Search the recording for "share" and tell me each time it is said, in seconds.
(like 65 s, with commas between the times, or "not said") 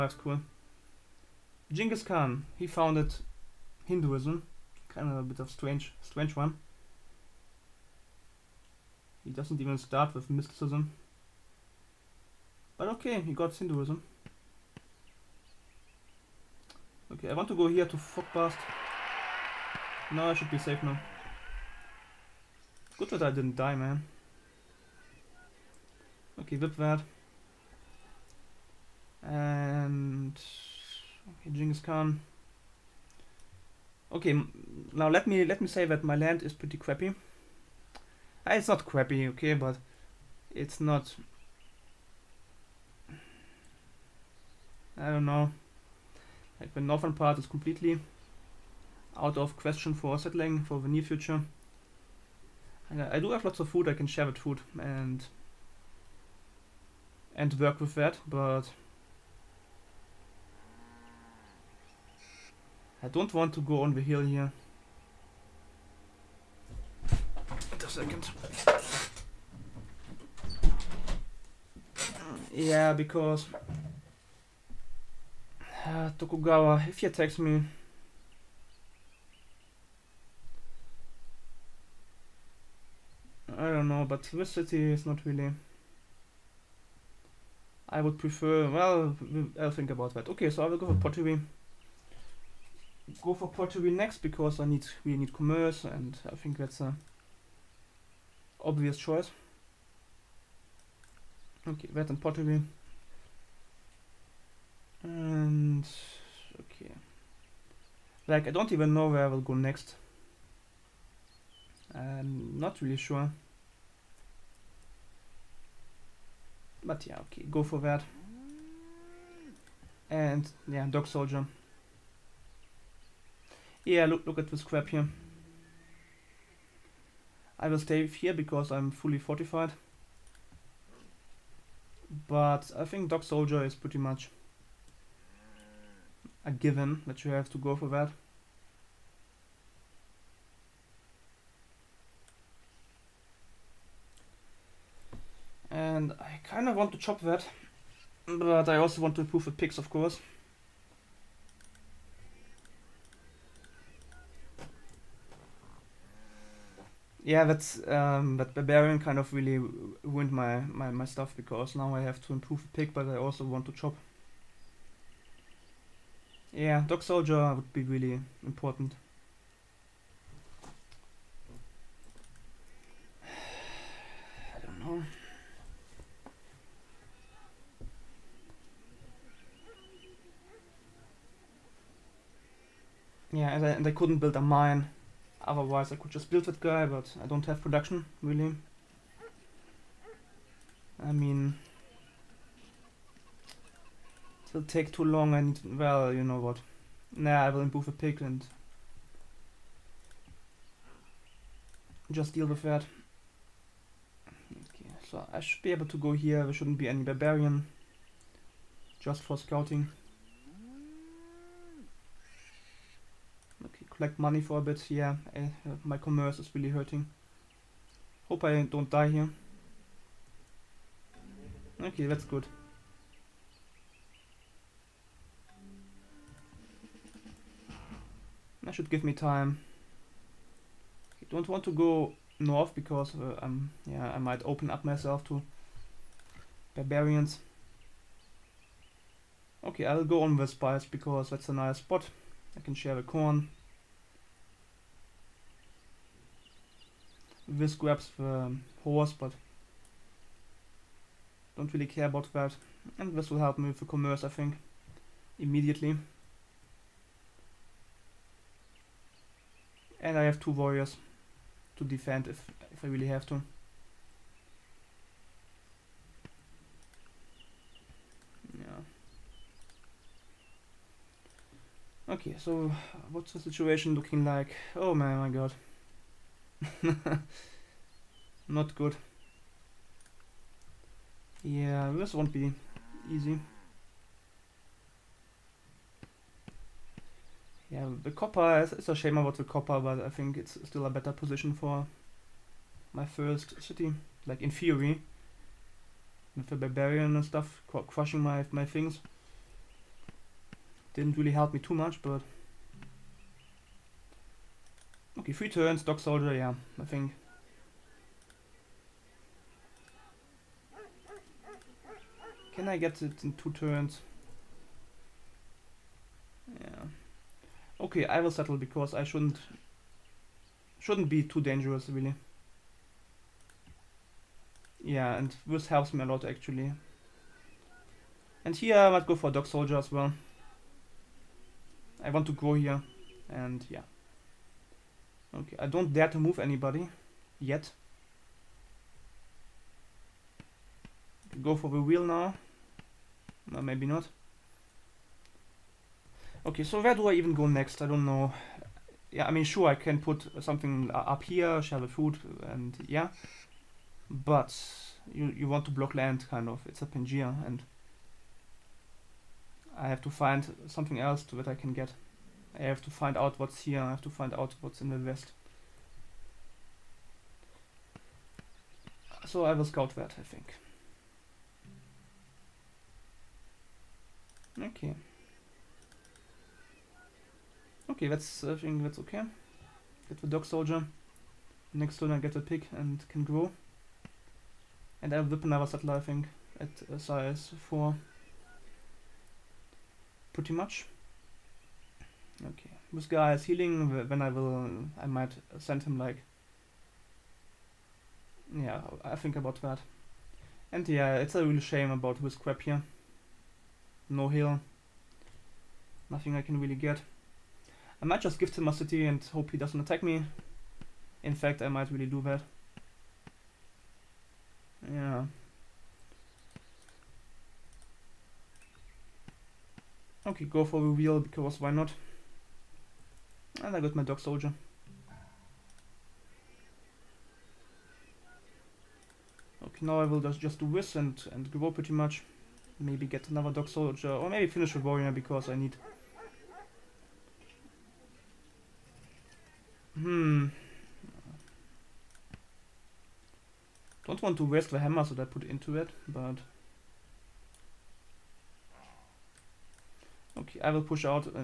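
54 s, 242 s, 351 s.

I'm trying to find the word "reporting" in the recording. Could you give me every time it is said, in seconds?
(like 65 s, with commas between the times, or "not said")
not said.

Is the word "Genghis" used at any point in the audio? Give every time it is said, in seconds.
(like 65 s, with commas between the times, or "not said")
1 s, 31 s.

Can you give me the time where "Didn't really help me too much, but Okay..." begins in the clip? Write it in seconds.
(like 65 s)
300 s.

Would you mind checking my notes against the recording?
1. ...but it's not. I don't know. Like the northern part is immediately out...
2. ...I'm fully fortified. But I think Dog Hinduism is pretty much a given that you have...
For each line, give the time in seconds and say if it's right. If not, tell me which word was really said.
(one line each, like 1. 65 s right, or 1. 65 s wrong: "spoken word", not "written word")
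1. 39 s wrong: "completely", not "immediately"
2. 128 s wrong: "Soldier", not "Hinduism".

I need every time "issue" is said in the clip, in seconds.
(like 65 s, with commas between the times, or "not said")
not said.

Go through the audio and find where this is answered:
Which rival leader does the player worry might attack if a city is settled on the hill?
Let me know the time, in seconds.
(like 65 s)
76 s.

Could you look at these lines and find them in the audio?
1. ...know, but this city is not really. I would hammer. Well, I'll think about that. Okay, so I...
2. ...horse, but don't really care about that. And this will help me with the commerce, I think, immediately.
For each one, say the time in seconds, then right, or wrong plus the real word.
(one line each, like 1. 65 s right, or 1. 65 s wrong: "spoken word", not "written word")
1. 83 s wrong: "prefer", not "hammer"
2. 248 s right.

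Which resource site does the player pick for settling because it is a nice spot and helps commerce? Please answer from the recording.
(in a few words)
Spice.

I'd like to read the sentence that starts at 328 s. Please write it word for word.
And here I might go for Dog Soldier as well.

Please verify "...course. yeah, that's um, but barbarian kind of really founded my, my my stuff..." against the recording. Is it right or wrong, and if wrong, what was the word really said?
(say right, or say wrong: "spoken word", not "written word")
wrong: "ruined", not "founded".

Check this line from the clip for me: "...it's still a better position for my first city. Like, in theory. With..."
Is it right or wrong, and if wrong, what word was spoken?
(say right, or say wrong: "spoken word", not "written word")
right.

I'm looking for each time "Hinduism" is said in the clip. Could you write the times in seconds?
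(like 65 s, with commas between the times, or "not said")
3 s, 13 s.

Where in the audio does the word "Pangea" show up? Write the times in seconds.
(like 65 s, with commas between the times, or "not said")
356 s.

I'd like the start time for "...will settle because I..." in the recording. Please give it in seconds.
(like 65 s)
318 s.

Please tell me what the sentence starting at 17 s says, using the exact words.
Okay, I want to go here to past.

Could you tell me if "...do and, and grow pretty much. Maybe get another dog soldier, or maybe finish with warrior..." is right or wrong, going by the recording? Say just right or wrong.
right.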